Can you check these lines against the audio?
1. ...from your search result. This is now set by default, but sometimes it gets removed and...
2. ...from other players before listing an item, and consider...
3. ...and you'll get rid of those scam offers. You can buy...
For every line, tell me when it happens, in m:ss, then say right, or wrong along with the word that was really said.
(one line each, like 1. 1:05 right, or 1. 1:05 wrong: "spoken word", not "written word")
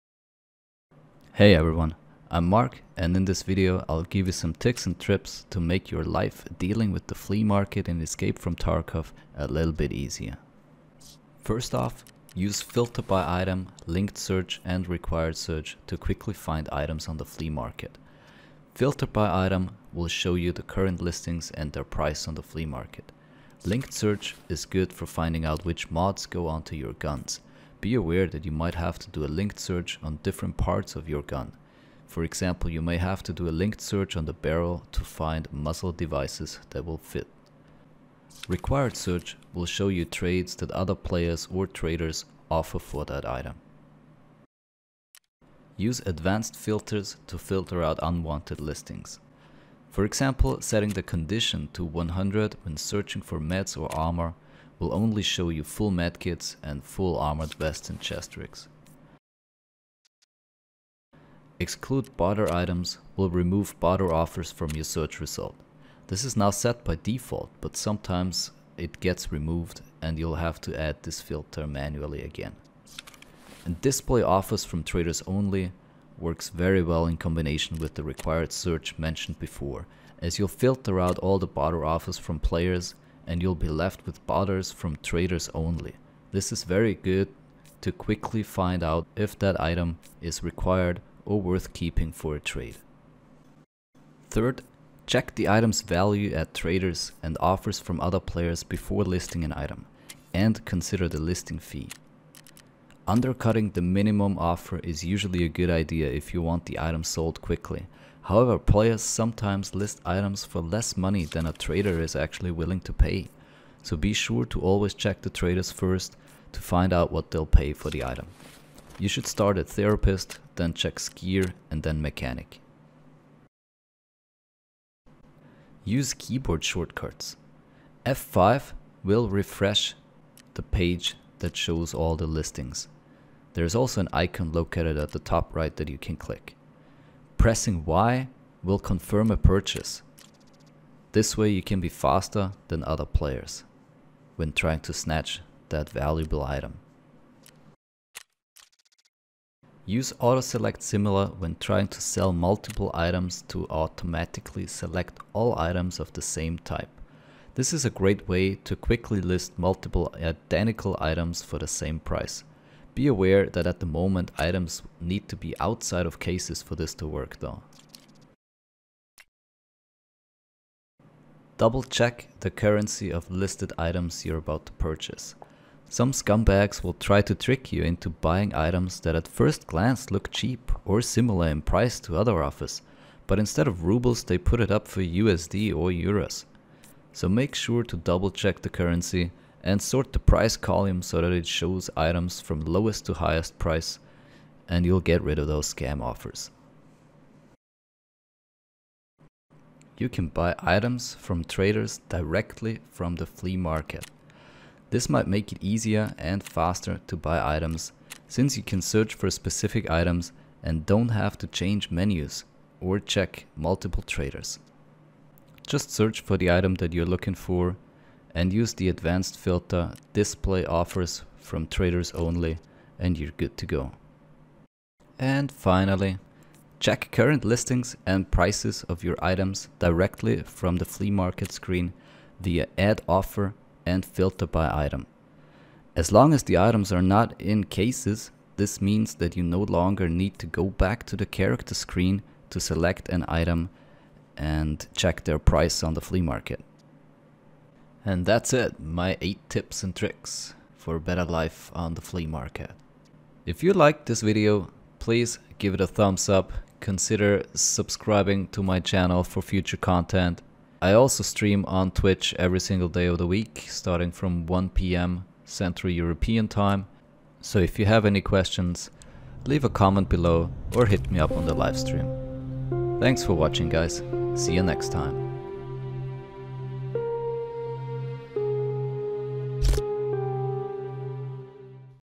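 1. 1:04 right
2. 1:37 right
3. 3:14 right.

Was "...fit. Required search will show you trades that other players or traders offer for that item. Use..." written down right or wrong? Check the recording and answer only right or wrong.
right.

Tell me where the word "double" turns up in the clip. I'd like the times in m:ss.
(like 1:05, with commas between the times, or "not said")
2:51, 3:07.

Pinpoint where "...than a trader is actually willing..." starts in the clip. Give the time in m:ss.
1:51.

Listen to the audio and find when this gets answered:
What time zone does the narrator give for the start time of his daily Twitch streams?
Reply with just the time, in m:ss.
4:25.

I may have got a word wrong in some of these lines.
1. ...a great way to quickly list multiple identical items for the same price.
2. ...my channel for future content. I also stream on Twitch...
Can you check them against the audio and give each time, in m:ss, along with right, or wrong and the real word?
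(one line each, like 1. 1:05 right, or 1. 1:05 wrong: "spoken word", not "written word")
1. 2:37 right
2. 4:18 right.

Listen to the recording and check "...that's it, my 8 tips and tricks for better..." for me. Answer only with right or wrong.
right.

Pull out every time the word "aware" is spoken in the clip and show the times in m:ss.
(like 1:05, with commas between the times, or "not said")
0:27, 2:43.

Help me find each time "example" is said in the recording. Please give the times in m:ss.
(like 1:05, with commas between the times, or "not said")
0:32, 0:50.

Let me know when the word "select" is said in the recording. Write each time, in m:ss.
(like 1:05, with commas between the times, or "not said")
2:30, 2:34, 4:02.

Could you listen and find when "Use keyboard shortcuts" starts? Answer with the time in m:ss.
2:05.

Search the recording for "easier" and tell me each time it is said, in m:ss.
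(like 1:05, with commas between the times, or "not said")
0:09, 3:25.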